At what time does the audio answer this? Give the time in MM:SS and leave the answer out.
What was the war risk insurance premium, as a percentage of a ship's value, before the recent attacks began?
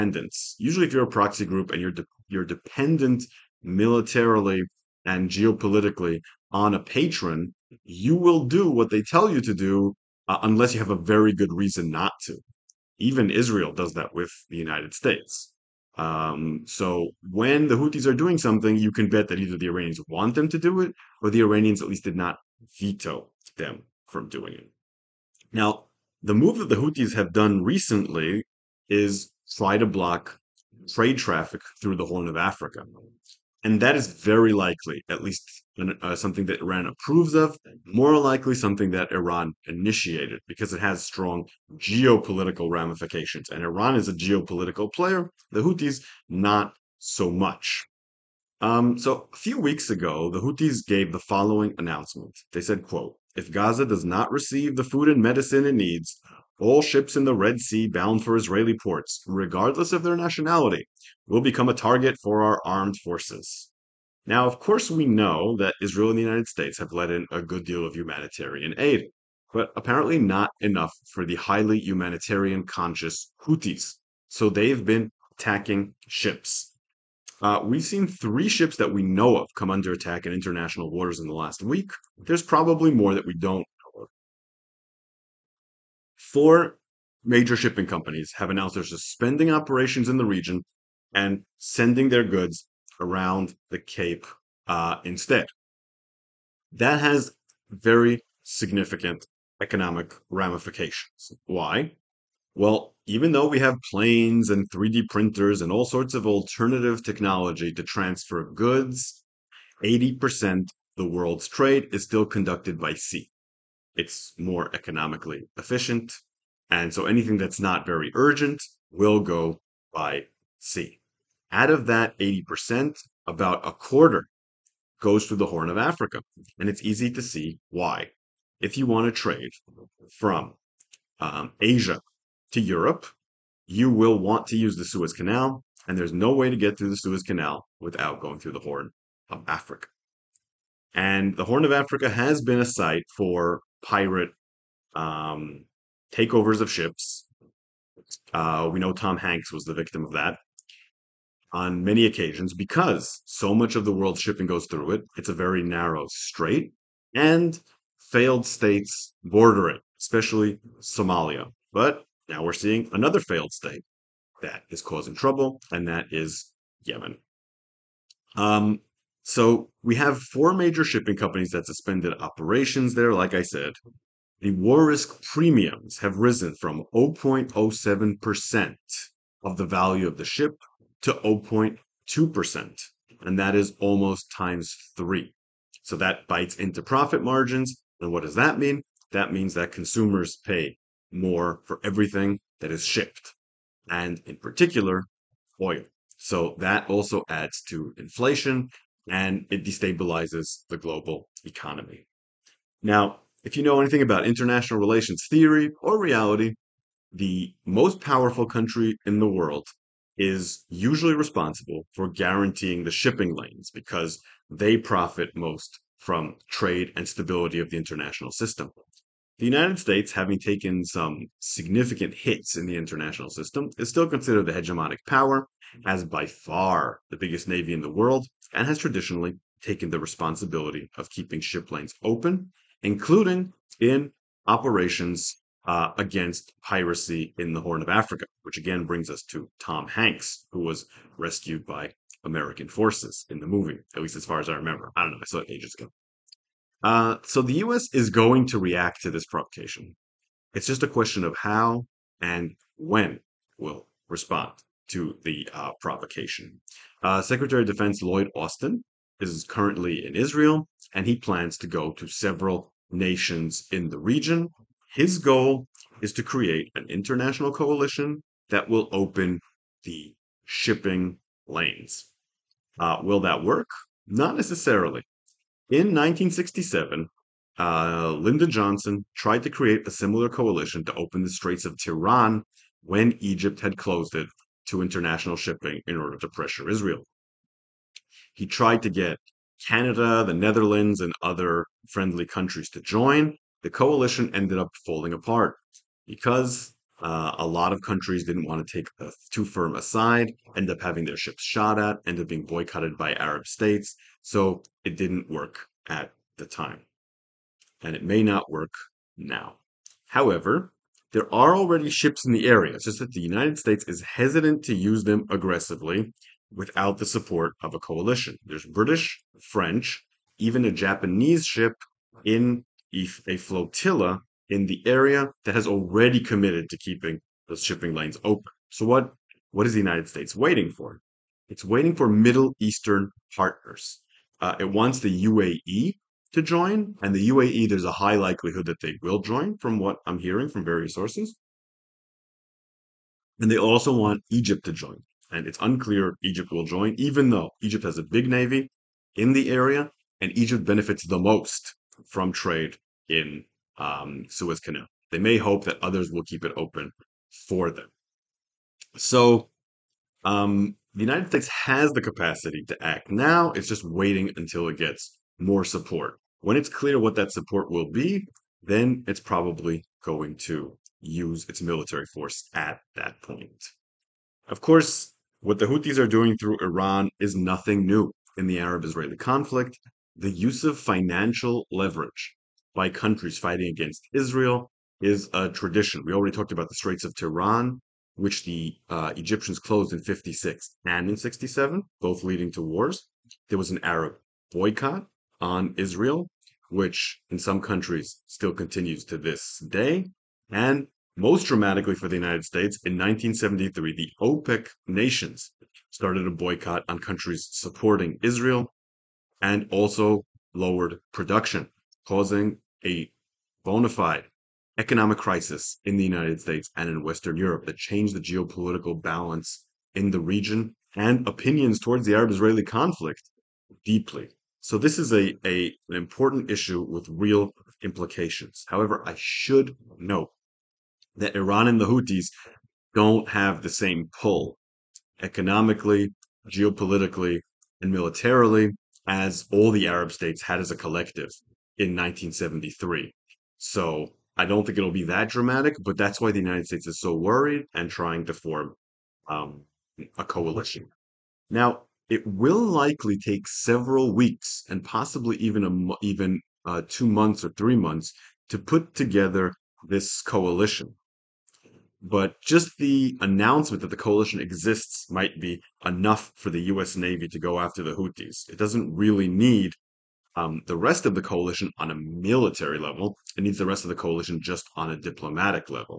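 02:56.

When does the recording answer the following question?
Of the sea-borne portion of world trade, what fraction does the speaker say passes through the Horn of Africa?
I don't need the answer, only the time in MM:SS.
02:03.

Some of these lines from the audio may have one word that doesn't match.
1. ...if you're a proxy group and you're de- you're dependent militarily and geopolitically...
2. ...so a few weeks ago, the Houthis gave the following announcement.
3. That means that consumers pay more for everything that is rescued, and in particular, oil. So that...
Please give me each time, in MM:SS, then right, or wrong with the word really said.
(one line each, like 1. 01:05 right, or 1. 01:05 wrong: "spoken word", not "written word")
1. 00:00 right
2. 00:48 right
3. 03:09 wrong: "shipped", not "rescued".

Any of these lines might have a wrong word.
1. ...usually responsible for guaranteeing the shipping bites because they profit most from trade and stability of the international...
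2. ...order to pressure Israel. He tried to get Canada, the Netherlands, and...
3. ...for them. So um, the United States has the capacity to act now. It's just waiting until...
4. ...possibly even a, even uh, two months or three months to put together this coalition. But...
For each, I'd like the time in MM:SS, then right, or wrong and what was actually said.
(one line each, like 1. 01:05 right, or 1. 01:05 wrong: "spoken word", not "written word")
1. 03:30 wrong: "lanes", not "bites"
2. 04:45 right
3. 05:57 right
4. 07:34 right.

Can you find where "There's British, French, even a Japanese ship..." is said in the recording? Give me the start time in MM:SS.
05:18.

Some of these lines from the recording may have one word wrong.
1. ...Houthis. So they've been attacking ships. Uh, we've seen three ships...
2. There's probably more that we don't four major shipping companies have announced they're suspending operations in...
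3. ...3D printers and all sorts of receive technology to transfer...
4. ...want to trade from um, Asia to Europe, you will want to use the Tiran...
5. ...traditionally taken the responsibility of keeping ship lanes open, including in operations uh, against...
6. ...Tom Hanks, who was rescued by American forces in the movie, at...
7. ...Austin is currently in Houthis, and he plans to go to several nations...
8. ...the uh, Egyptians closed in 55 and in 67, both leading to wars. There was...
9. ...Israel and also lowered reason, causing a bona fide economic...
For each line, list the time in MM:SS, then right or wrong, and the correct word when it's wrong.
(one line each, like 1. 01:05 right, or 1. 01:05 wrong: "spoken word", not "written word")
1. 01:13 right
2. 01:22 right
3. 01:44 wrong: "alternative", not "receive"
4. 02:08 wrong: "Suez", not "Tiran"
5. 03:48 right
6. 03:59 right
7. 04:18 wrong: "Israel", not "Houthis"
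8. 06:28 wrong: "56", not "55"
9. 06:48 wrong: "production", not "reason".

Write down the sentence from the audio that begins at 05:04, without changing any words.
So it didn't work at the time.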